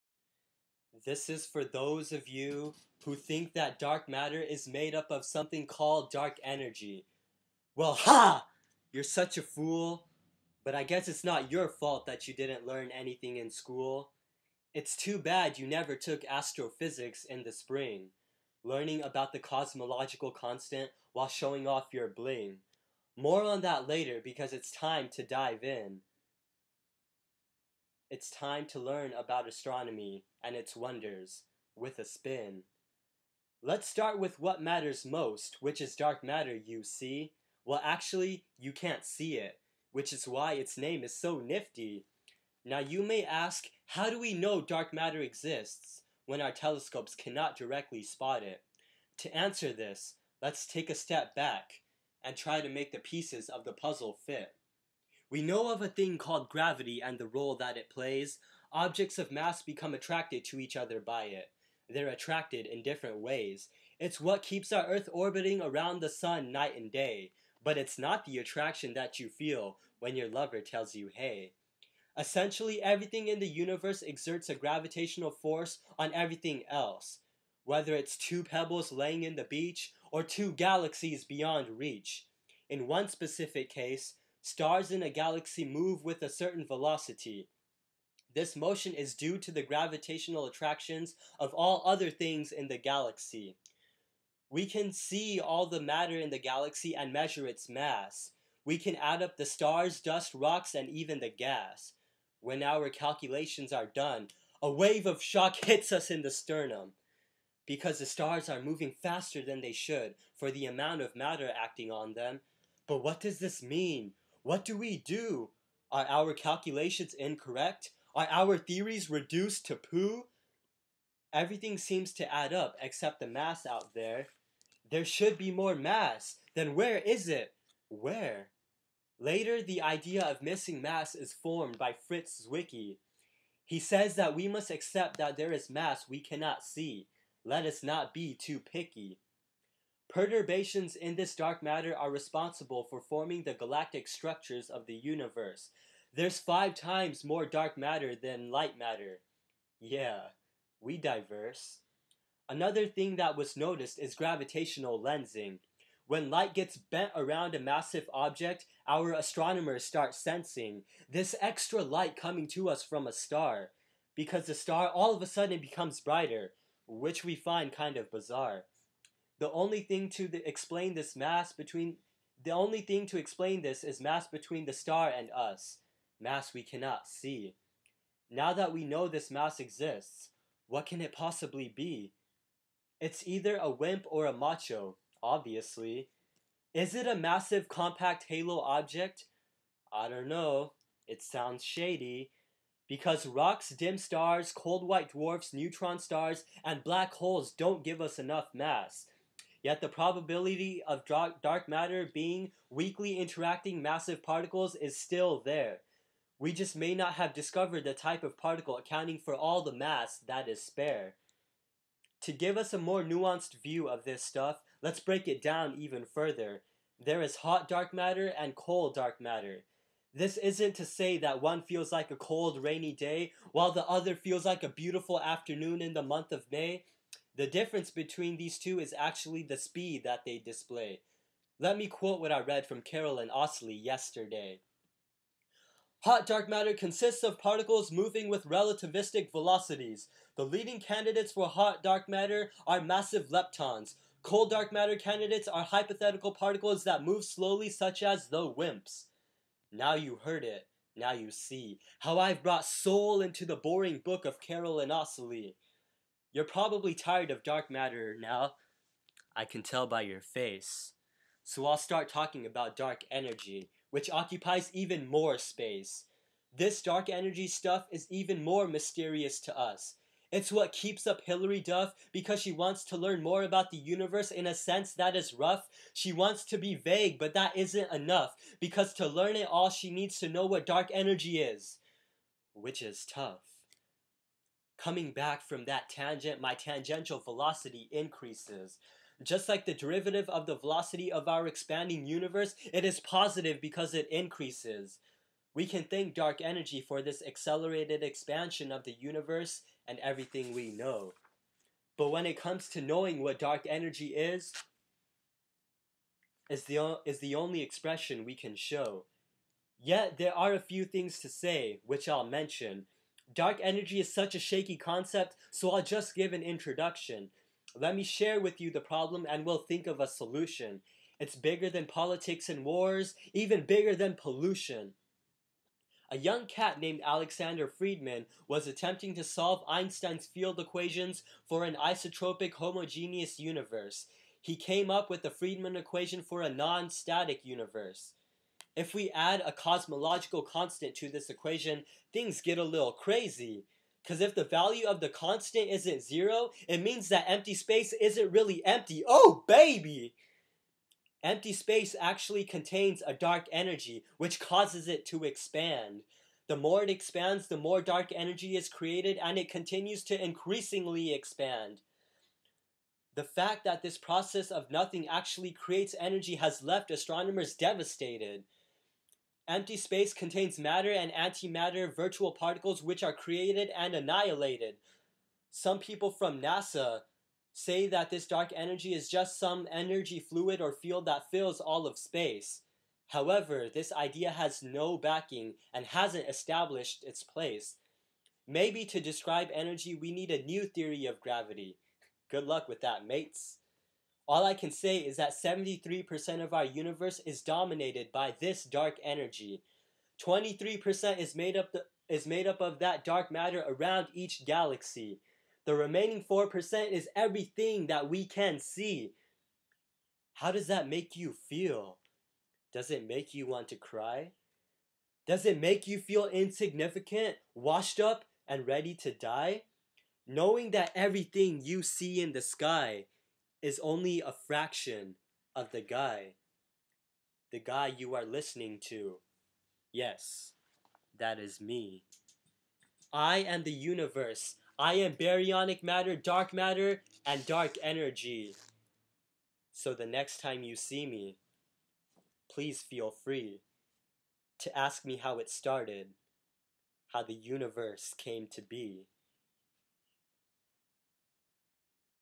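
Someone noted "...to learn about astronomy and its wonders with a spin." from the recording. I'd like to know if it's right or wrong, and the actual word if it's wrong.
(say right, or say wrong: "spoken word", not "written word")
right.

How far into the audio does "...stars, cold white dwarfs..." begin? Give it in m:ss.
3:13.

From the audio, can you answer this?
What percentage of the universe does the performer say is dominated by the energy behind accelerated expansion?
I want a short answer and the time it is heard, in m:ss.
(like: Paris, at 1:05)
73%, at 6:35.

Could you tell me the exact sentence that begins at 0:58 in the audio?
Objects of mass become attracted to each other by it.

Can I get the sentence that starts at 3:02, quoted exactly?
It's either a WIMP or a MACHO, obviously.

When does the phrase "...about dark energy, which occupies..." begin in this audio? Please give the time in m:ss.
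4:22.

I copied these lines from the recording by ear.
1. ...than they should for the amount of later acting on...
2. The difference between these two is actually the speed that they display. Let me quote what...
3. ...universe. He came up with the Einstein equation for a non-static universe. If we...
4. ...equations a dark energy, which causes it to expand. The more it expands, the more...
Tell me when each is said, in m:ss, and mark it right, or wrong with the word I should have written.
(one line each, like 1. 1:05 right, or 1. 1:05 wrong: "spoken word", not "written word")
1. 1:49 wrong: "matter", not "later"
2. 3:47 right
3. 5:33 wrong: "Friedmann", not "Einstein"
4. 5:52 wrong: "contains", not "equations".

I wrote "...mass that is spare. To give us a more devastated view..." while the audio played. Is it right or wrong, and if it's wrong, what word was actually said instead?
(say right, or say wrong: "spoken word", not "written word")
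wrong: "nuanced", not "devastated".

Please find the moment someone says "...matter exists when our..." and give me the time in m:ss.
0:44.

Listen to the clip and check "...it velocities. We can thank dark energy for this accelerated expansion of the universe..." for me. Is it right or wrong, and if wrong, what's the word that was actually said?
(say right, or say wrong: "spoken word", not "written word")
wrong: "increases", not "velocities".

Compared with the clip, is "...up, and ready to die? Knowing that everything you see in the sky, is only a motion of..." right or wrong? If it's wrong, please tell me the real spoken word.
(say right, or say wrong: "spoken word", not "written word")
wrong: "fraction", not "motion".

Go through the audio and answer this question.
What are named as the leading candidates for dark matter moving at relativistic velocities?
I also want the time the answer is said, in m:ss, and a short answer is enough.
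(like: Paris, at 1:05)
massive leptons, at 4:02.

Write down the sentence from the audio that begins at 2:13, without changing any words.
He says that we must accept that there is mass we cannot see.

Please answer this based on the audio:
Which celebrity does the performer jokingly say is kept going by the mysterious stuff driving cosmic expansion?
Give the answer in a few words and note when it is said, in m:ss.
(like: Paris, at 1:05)
Hilary Duff, at 4:31.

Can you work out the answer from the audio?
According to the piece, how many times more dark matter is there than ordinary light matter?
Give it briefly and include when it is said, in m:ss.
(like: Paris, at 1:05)
5, at 2:26.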